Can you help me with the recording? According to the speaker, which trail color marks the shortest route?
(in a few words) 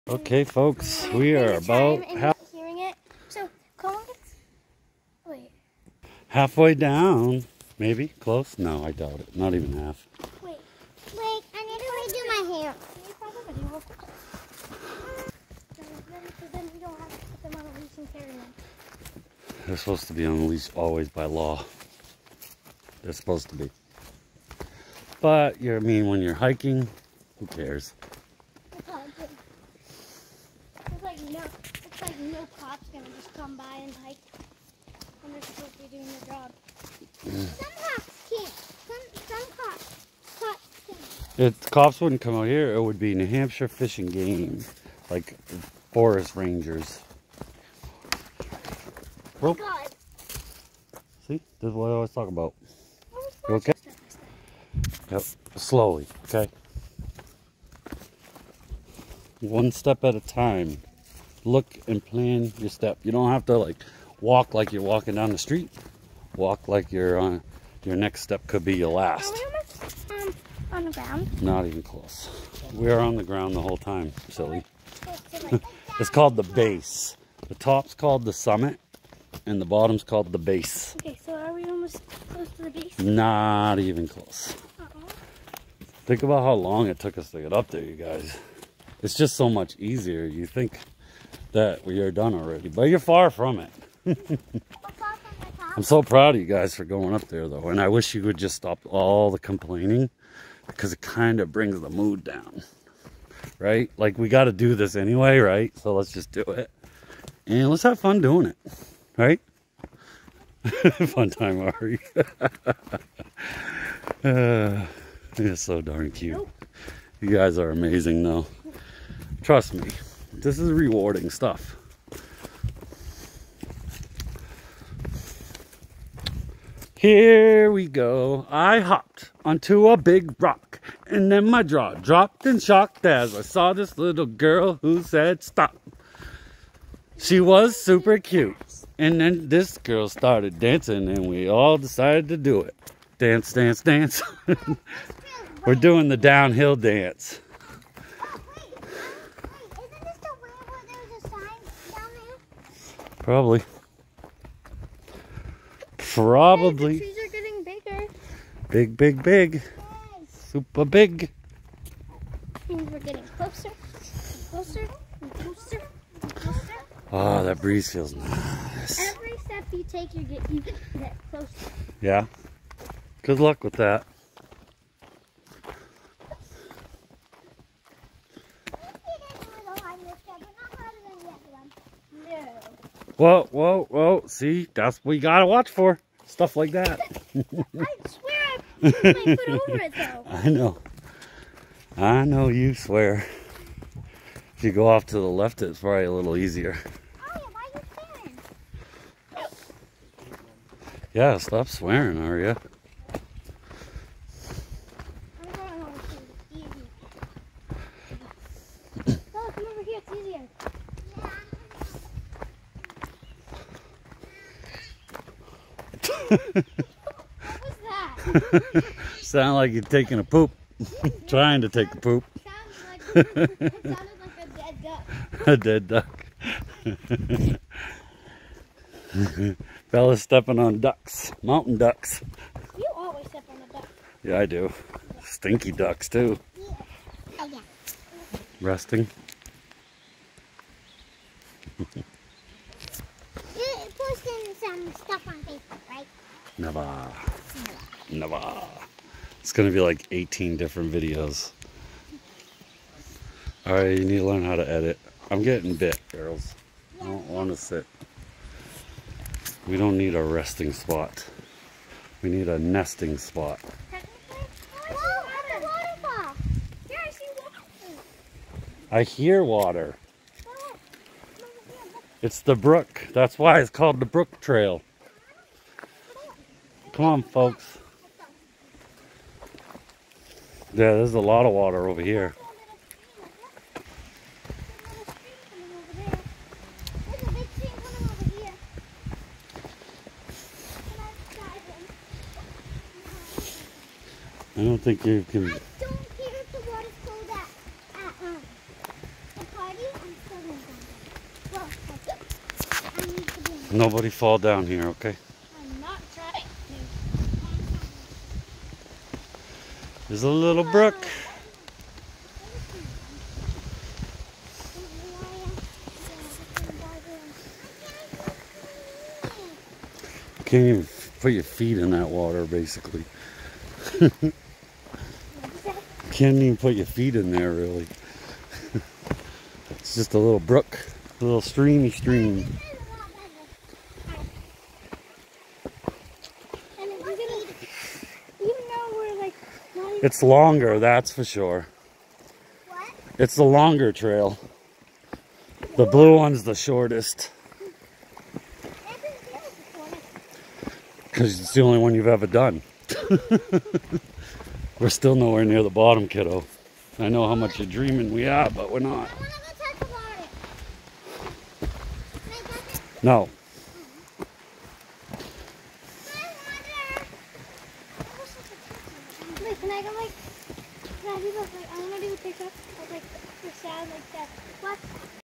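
blue.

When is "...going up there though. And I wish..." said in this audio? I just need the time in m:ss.
1:36.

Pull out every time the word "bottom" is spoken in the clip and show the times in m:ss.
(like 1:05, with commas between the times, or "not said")
1:19, 5:55.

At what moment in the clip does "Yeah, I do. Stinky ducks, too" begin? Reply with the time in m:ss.
3:54.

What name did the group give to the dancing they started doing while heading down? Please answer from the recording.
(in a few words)
downhill dance.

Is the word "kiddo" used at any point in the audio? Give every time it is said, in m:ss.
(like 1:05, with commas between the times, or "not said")
5:56.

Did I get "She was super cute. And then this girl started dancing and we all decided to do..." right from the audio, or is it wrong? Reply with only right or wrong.
right.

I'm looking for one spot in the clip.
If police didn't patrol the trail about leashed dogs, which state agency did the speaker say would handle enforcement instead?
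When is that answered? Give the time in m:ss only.
0:43.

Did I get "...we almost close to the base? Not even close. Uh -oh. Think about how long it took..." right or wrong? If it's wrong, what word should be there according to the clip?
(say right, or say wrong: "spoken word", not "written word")
right.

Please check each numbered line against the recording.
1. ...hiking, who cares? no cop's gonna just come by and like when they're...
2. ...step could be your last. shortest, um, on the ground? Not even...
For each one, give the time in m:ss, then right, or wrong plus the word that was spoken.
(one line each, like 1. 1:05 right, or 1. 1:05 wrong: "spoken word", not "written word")
1. 0:26 right
2. 1:08 wrong: "almost", not "shortest".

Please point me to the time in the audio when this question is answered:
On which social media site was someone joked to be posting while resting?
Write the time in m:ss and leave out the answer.
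4:05.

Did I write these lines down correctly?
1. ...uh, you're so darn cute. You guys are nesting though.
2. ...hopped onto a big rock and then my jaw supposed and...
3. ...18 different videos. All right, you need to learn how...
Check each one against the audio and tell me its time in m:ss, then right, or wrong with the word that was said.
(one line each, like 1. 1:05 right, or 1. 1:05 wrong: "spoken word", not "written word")
1. 1:54 wrong: "amazing", not "nesting"
2. 2:08 wrong: "dropped", not "supposed"
3. 4:10 right.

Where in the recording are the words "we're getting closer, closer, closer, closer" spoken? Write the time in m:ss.
2:42.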